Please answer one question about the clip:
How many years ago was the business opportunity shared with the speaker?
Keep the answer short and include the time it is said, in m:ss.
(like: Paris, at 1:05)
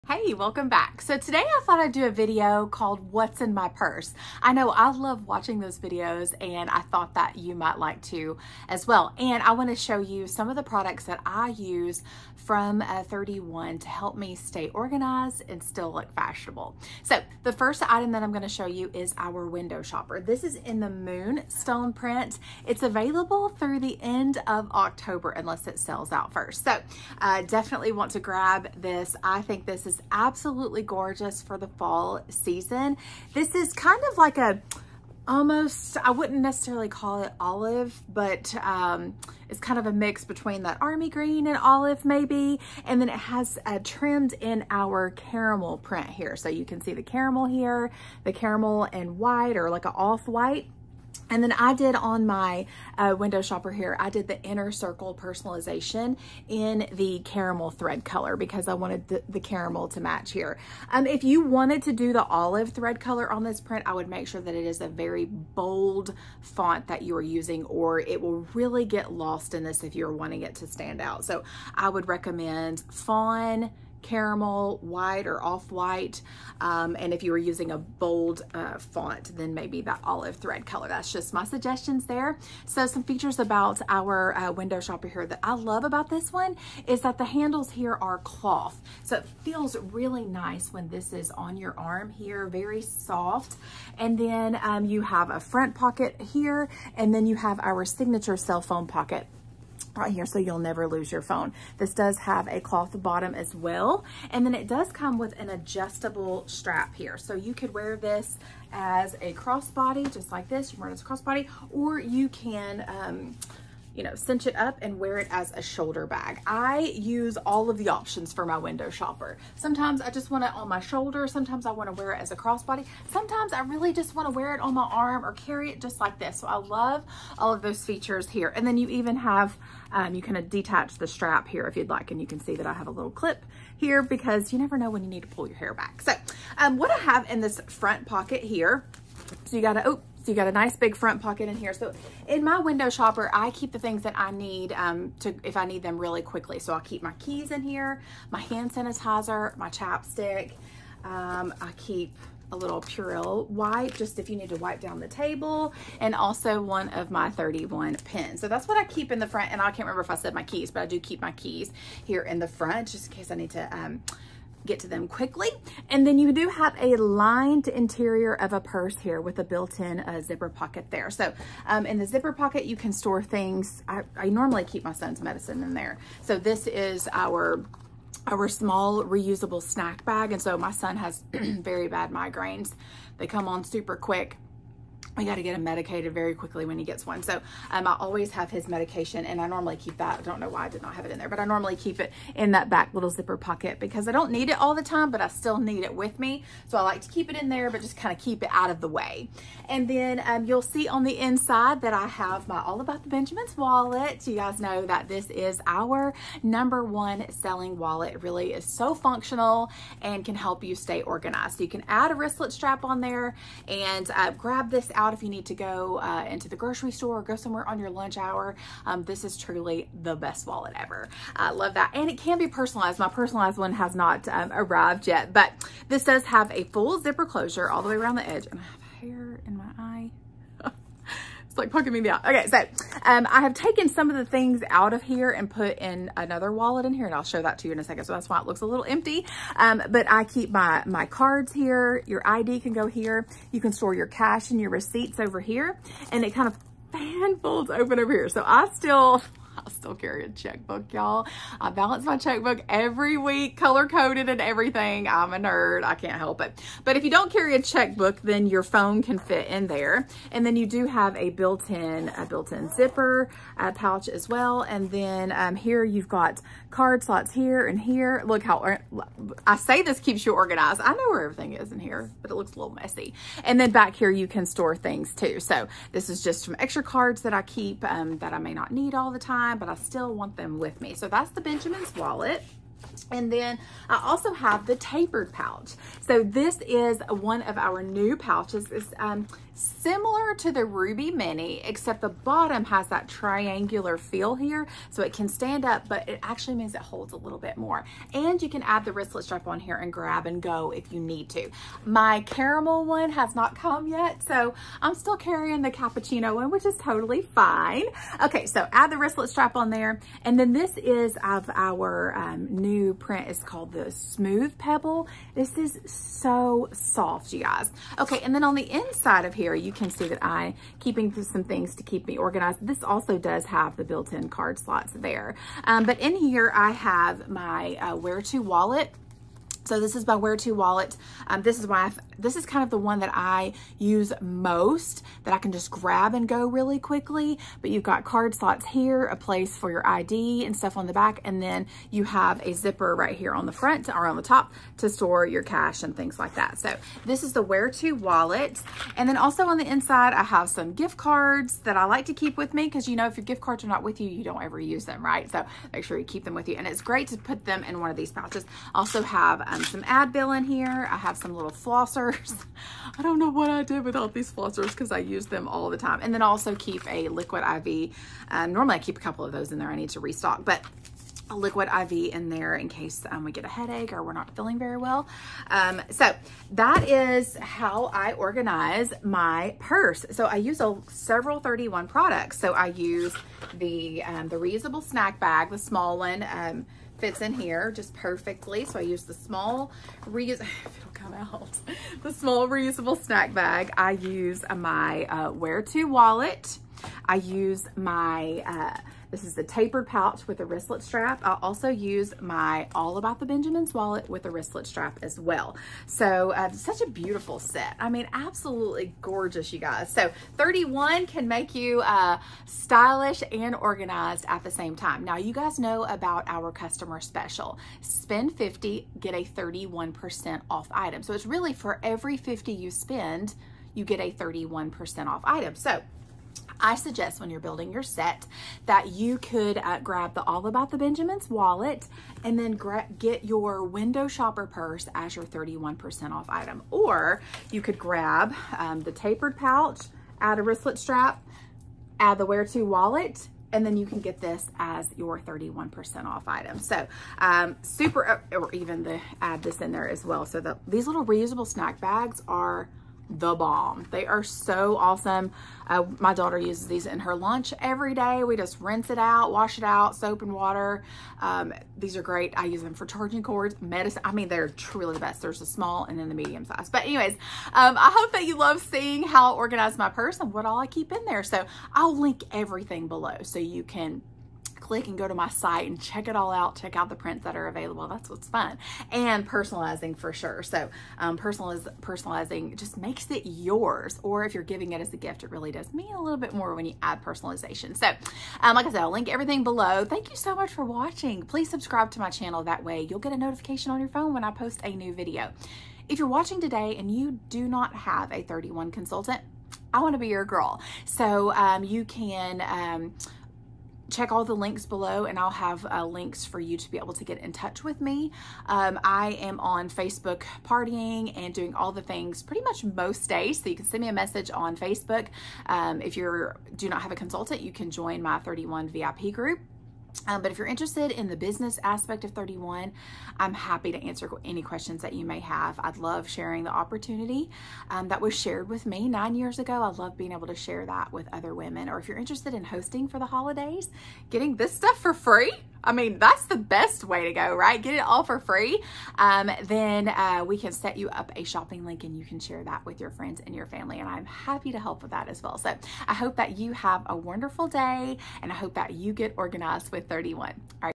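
9, at 8:48.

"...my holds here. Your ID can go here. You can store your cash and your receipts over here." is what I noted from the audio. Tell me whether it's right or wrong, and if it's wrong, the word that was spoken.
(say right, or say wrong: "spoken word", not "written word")
wrong: "cards", not "holds".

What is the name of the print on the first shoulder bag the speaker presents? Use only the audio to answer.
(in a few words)
Moonstone.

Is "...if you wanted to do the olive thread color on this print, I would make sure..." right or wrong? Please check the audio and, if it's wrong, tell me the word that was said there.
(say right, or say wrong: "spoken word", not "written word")
right.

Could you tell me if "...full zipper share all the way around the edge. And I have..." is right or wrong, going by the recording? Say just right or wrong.
wrong.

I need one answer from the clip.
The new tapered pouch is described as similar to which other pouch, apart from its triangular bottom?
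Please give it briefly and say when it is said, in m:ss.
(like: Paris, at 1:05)
Ruby Mini, at 4:50.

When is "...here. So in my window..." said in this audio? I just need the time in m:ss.
2:21.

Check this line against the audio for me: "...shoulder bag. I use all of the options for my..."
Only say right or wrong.
right.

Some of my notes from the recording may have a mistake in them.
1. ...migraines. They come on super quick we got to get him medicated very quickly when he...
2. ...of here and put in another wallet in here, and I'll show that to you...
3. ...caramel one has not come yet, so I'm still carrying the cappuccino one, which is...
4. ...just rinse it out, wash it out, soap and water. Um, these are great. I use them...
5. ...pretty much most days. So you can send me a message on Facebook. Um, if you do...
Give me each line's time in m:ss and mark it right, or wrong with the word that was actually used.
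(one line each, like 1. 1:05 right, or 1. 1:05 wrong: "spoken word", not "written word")
1. 3:02 right
2. 3:54 right
3. 5:02 right
4. 7:38 right
5. 8:32 right.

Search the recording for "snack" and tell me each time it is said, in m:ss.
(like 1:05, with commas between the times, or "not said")
2:59, 6:24, 6:33, 7:31.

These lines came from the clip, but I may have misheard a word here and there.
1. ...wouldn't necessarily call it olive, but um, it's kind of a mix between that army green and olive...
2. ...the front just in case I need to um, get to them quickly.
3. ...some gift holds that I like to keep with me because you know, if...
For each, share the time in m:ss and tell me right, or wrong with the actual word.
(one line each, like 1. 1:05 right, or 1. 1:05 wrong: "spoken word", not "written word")
1. 0:36 right
2. 2:42 right
3. 5:50 wrong: "cards", not "holds".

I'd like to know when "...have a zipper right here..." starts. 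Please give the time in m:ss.
5:42.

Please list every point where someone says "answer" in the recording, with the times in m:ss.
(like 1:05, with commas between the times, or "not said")
8:43.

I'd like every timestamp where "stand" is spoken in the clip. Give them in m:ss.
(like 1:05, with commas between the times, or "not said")
1:10, 4:55.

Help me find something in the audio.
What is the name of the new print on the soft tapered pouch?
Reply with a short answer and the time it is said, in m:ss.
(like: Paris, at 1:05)
Smooth Pebble, at 5:13.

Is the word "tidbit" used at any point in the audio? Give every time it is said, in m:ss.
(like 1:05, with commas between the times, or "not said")
not said.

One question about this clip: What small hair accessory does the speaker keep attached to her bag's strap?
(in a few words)
clip.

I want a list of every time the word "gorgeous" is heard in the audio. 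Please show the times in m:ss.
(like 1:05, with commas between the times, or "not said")
0:30, 6:49.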